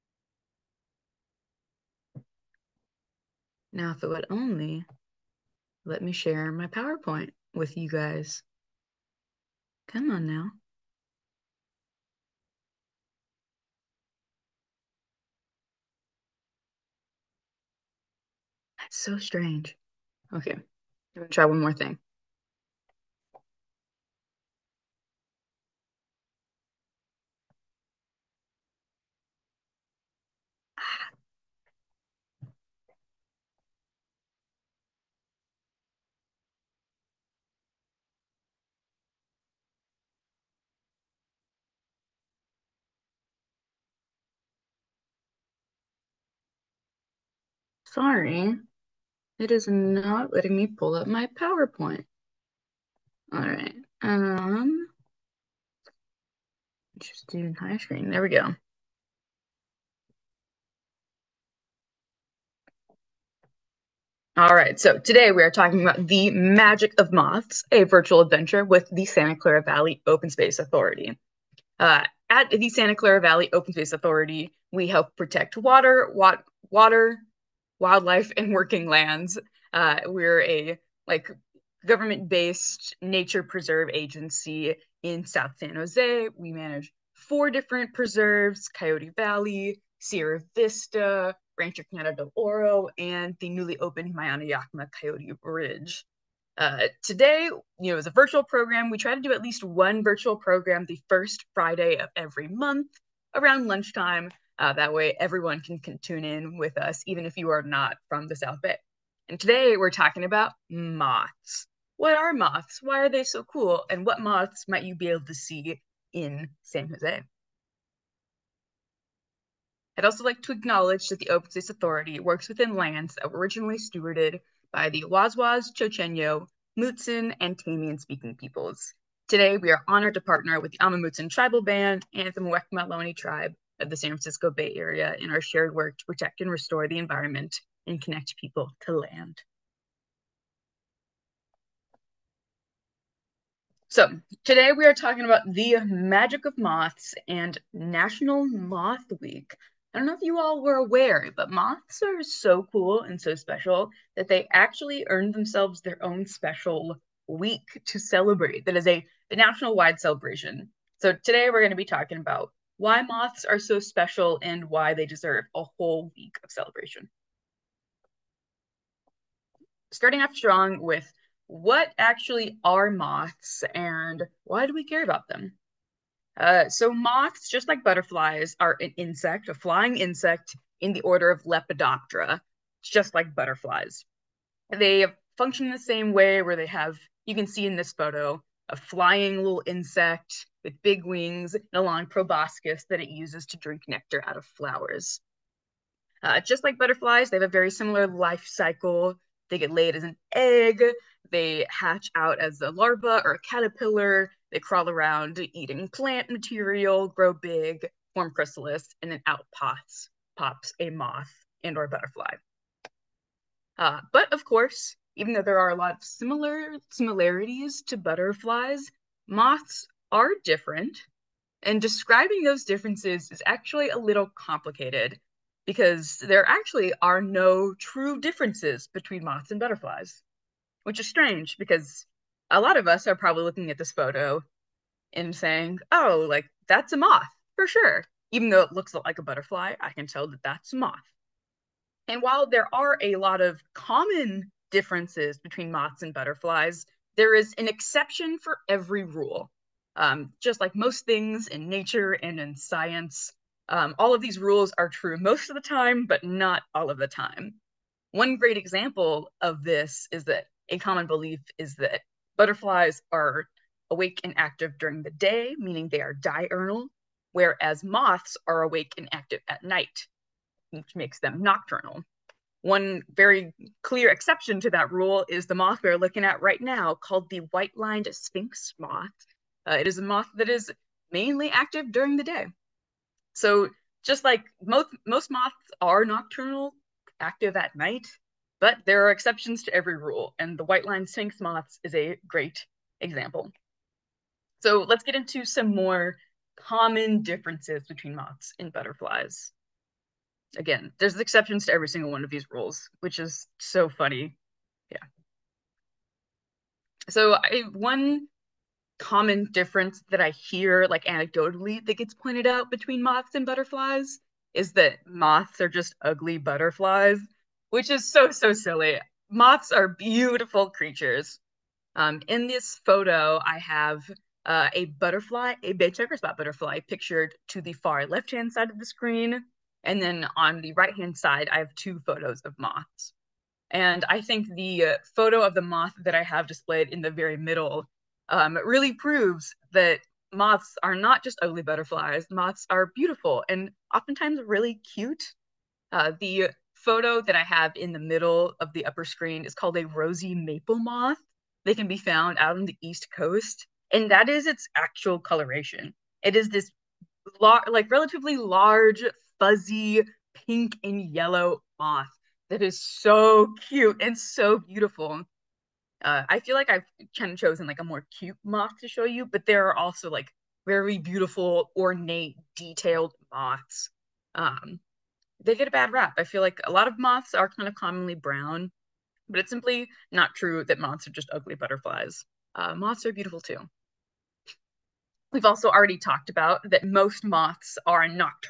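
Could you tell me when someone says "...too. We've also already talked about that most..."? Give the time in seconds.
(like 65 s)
383 s.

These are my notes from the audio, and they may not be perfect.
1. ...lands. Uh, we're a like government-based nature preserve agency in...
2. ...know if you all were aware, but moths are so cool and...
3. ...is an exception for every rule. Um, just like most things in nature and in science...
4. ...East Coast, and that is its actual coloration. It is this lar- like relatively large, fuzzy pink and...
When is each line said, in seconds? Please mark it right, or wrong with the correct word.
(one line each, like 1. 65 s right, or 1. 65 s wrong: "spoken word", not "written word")
1. 78 s right
2. 150 s right
3. 247 s right
4. 352 s right.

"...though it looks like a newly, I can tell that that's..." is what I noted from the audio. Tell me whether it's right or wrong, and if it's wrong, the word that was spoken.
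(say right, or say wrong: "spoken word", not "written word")
wrong: "butterfly", not "newly".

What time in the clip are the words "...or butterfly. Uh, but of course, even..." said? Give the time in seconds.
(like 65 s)
211 s.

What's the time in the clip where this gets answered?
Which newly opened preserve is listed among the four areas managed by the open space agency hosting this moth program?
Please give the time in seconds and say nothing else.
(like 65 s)
94 s.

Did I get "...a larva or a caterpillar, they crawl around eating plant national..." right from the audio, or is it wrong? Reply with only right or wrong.
wrong.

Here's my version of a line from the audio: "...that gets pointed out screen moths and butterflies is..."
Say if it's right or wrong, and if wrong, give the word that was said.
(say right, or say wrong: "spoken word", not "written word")
wrong: "between", not "screen".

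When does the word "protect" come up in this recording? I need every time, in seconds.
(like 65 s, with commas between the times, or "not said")
75 s, 136 s.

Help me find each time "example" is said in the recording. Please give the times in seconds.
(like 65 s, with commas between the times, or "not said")
258 s, 293 s.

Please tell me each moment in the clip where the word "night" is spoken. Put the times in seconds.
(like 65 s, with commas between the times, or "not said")
269 s, 287 s.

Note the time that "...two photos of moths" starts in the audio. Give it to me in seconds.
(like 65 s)
331 s.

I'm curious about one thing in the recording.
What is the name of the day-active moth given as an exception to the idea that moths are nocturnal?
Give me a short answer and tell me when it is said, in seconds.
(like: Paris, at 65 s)
White lined sphinx moth, at 277 s.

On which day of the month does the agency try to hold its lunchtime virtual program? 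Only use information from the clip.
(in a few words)
First Friday.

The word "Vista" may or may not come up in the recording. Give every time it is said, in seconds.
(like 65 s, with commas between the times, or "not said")
90 s.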